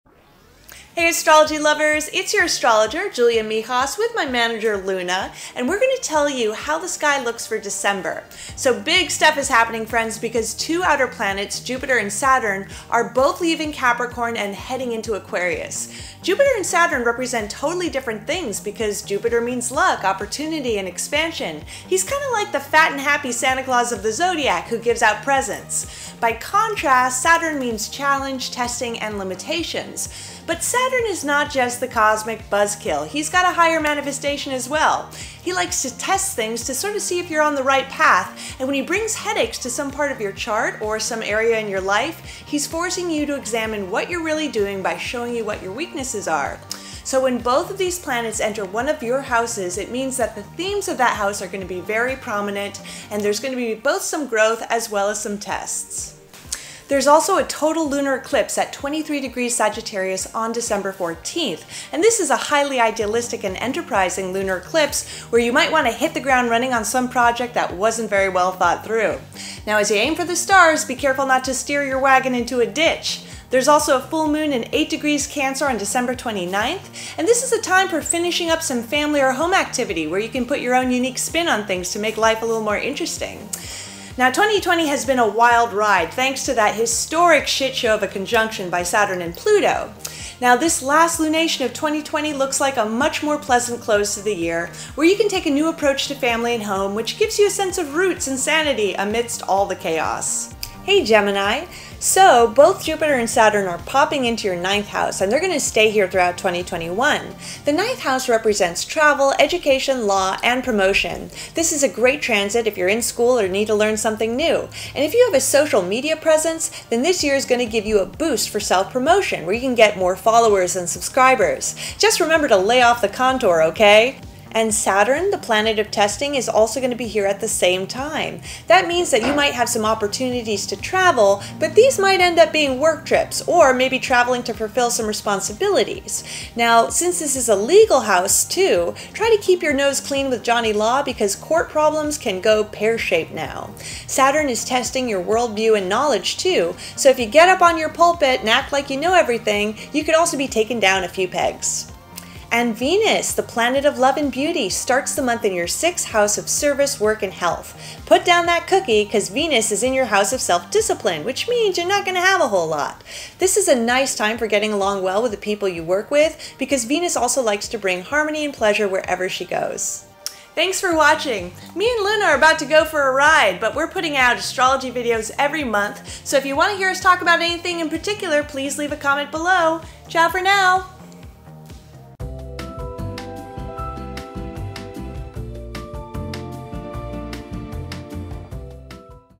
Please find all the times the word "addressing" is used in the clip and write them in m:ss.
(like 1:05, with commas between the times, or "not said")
not said.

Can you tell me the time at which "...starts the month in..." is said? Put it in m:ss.
2:34.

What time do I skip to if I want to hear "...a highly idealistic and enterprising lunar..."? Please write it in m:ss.
1:02.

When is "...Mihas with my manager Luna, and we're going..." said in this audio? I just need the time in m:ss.
0:03.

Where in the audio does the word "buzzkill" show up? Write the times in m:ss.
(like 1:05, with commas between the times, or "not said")
0:32.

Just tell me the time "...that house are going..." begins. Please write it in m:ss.
0:50.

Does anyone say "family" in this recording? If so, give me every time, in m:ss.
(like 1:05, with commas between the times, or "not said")
1:18, 1:36.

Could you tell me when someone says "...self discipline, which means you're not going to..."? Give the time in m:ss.
2:40.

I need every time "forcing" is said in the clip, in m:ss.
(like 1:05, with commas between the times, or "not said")
0:42.